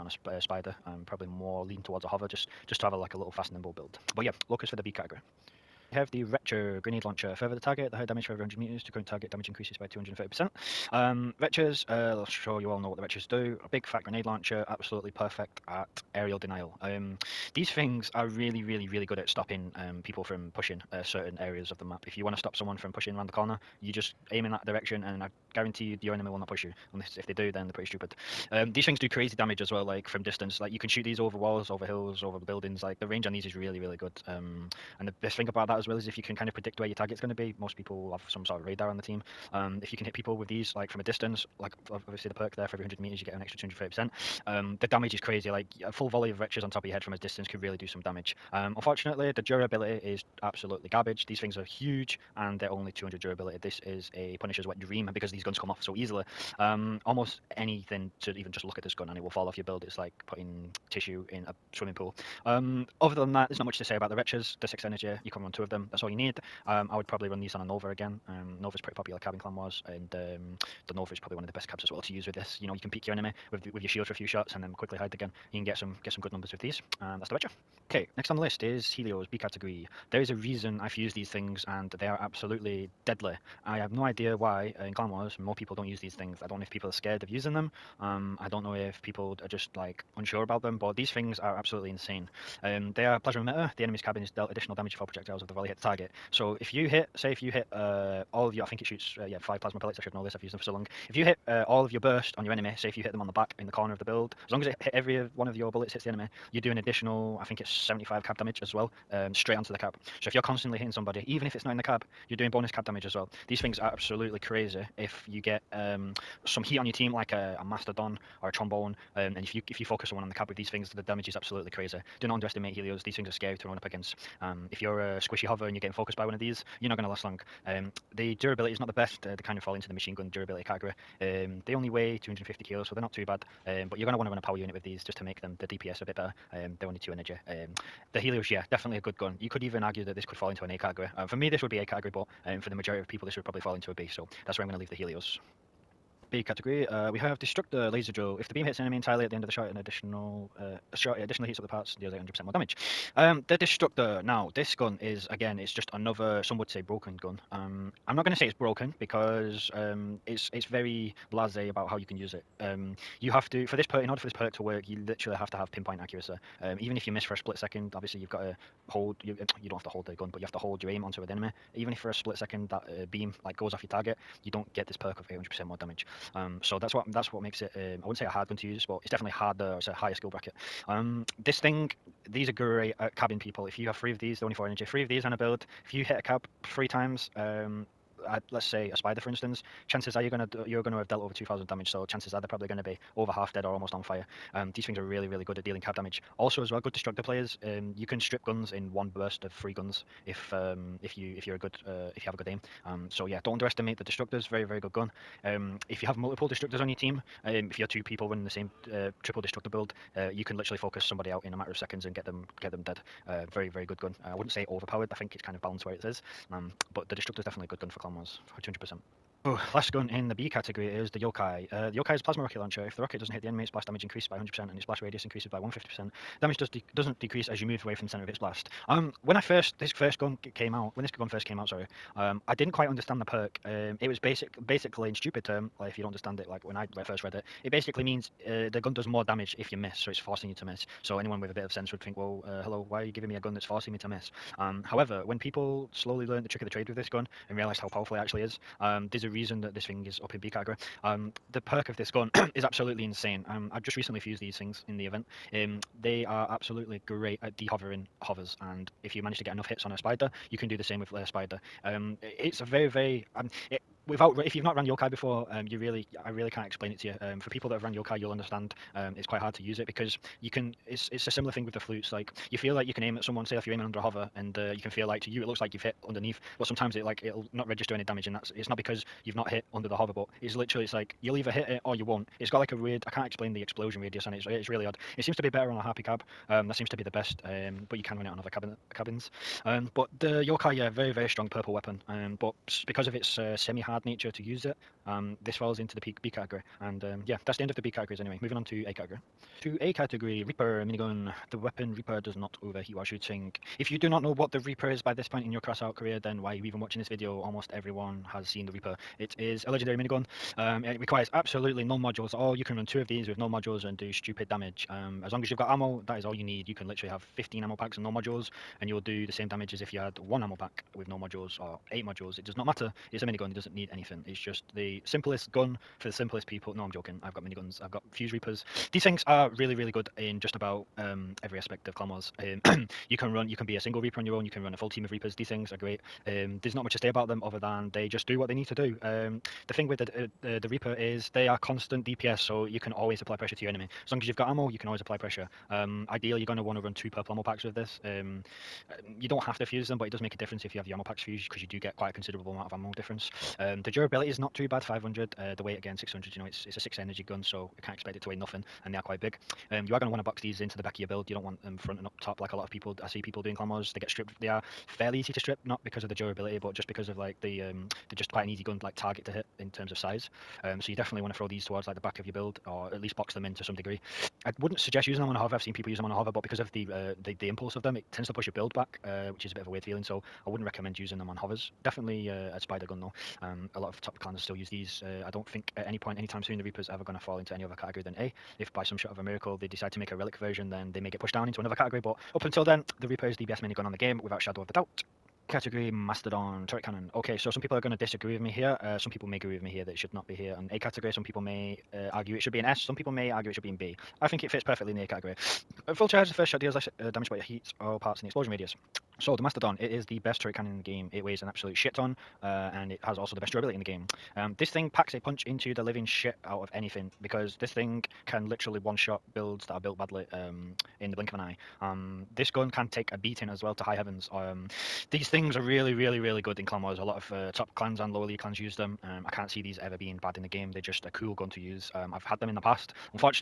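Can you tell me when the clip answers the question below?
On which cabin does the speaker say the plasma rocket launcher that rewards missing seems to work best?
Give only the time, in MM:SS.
04:45.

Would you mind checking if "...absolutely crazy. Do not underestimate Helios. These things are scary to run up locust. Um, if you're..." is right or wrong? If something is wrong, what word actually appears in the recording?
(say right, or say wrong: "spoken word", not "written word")
wrong: "against", not "locust".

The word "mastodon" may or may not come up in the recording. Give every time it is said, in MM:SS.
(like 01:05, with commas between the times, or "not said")
01:57, 06:35, 06:49.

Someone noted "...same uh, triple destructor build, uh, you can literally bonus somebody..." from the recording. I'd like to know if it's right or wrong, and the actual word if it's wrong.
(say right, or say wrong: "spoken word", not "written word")
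wrong: "focus", not "bonus".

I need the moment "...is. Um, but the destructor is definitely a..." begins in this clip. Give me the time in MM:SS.
03:36.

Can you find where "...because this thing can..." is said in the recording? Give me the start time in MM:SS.
06:57.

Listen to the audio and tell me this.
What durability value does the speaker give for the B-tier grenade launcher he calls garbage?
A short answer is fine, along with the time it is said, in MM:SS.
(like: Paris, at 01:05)
200, at 00:52.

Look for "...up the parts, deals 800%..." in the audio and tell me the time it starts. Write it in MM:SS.
02:31.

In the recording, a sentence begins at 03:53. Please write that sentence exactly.
Um, it was basic, basically in stupid term.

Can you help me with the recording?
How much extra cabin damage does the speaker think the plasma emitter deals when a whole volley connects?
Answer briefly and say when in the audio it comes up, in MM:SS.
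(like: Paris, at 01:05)
75, at 01:47.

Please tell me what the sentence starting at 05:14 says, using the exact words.
Um, as long as you've got ammo, that is all you need.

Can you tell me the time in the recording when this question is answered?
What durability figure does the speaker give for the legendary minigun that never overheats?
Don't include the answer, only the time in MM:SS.
05:54.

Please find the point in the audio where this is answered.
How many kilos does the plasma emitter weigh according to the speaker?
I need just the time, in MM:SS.
02:12.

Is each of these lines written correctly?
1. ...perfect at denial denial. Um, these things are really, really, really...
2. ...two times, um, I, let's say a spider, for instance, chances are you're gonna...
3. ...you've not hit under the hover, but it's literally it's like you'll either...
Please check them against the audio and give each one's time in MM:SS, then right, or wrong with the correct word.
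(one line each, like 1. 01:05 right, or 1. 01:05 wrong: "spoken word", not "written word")
1. 00:15 wrong: "aerial", not "denial"
2. 03:06 wrong: "three", not "two"
3. 04:39 right.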